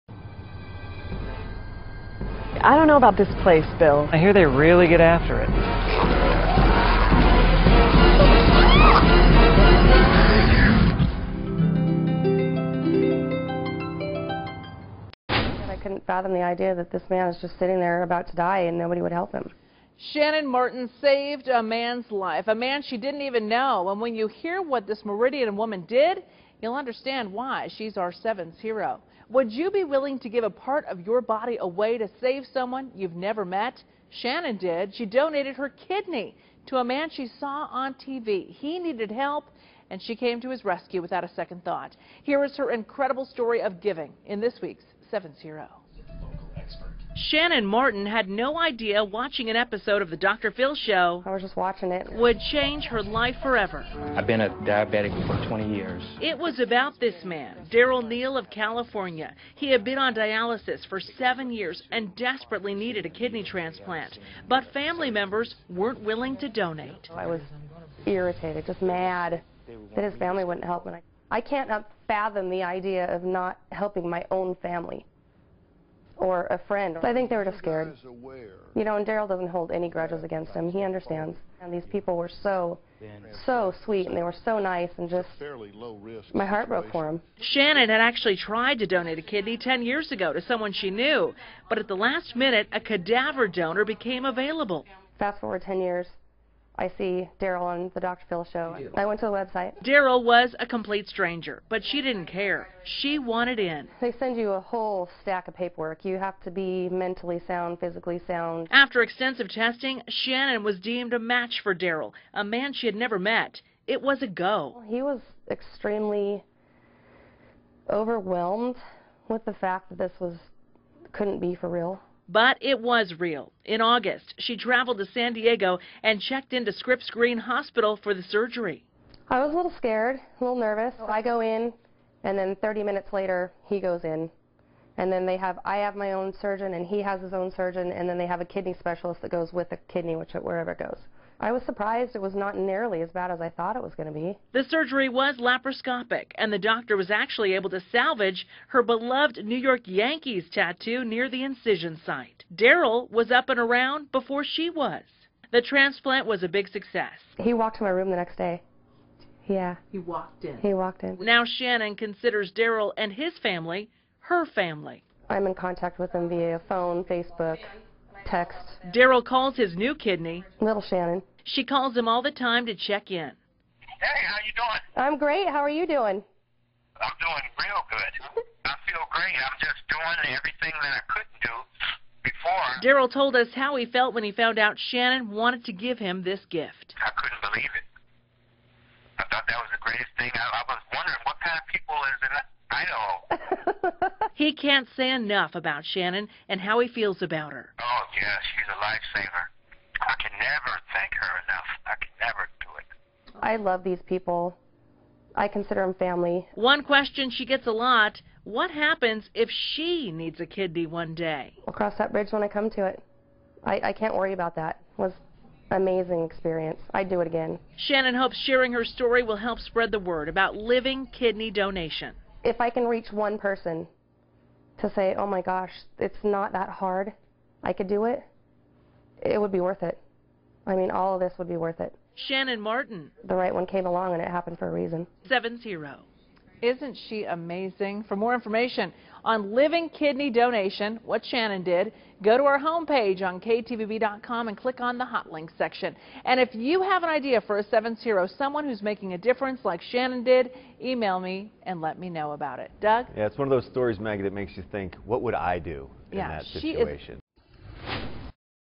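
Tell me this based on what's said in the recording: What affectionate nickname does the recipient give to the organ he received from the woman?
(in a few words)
Little Shannon.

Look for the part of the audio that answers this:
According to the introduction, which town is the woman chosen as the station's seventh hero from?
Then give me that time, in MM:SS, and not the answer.
00:25.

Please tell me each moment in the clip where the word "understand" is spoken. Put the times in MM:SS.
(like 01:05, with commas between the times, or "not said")
00:26, 01:20.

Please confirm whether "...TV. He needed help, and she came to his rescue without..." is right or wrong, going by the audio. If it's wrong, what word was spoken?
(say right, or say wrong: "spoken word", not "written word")
right.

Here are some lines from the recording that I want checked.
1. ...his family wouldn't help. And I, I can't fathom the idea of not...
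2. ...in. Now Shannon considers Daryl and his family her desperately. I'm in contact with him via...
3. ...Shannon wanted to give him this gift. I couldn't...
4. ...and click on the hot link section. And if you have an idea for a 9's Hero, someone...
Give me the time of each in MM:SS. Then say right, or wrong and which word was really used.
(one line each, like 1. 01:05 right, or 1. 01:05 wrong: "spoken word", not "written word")
1. 01:10 right
2. 02:41 wrong: "family", not "desperately"
3. 03:04 right
4. 04:04 wrong: "7", not "9".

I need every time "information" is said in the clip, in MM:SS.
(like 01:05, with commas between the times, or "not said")
03:58.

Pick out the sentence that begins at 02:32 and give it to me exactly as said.
Daryl was up and around before she was.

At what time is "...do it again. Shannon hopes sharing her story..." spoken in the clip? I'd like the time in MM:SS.
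03:37.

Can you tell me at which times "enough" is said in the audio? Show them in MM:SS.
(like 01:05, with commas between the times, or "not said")
03:15, 03:21.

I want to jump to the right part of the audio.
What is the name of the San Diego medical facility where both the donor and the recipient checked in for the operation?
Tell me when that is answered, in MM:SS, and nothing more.
02:06.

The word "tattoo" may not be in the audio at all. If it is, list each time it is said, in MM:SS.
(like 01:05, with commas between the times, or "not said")
02:30.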